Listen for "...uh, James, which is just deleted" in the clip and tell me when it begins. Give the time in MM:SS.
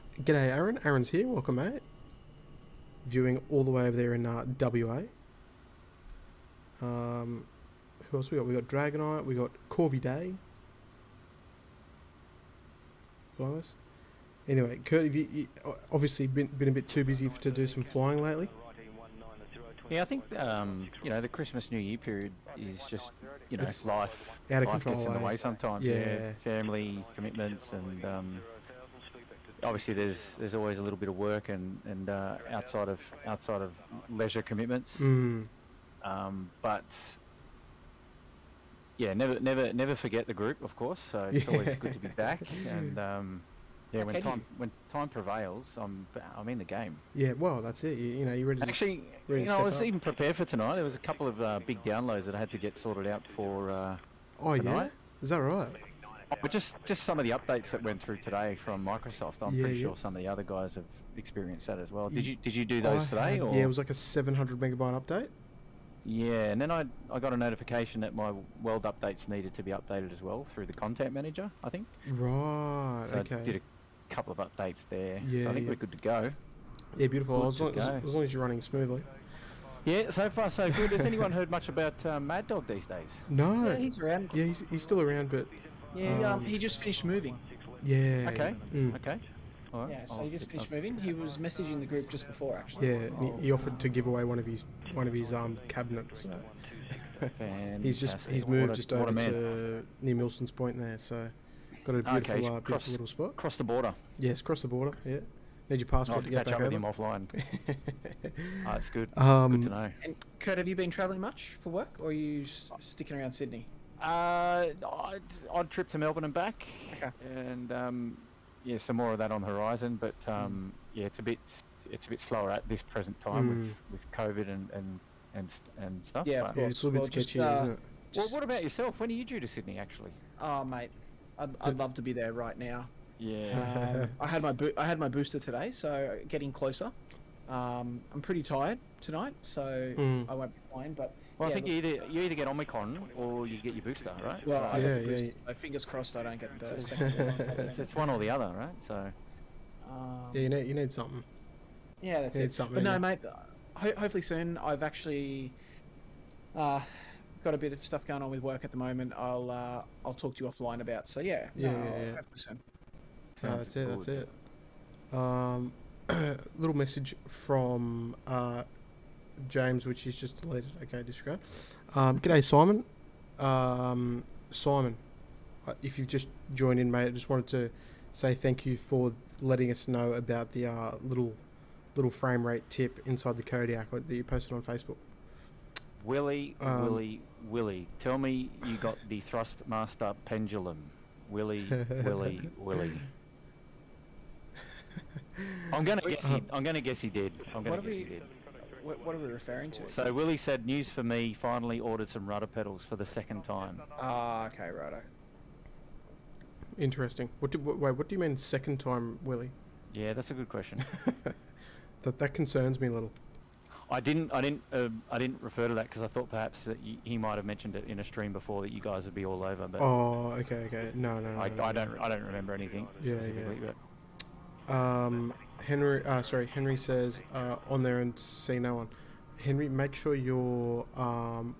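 02:48.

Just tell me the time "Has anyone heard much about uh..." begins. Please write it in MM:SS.
01:20.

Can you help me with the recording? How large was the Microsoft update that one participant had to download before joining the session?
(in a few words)
700 megabytes.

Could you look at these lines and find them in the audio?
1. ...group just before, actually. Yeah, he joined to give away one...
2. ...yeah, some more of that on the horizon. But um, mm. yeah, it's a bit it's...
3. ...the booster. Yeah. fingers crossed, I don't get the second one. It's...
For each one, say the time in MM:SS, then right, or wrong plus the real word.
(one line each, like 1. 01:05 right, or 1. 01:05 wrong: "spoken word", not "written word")
1. 01:31 wrong: "offered", not "joined"
2. 01:58 right
3. 02:25 right.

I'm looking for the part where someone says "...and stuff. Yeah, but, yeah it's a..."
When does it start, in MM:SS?
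02:05.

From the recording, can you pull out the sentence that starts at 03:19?
So Willie said, news for me, finally ordered some rudder pedals for the second time.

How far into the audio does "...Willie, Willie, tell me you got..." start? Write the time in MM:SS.
03:06.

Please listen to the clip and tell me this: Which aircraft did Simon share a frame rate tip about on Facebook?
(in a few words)
Kodiak.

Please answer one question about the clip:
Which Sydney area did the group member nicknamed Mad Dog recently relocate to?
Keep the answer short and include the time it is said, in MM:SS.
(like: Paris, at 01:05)
Milson's Point, at 01:40.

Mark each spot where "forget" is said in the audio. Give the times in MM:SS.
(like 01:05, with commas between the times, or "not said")
00:39.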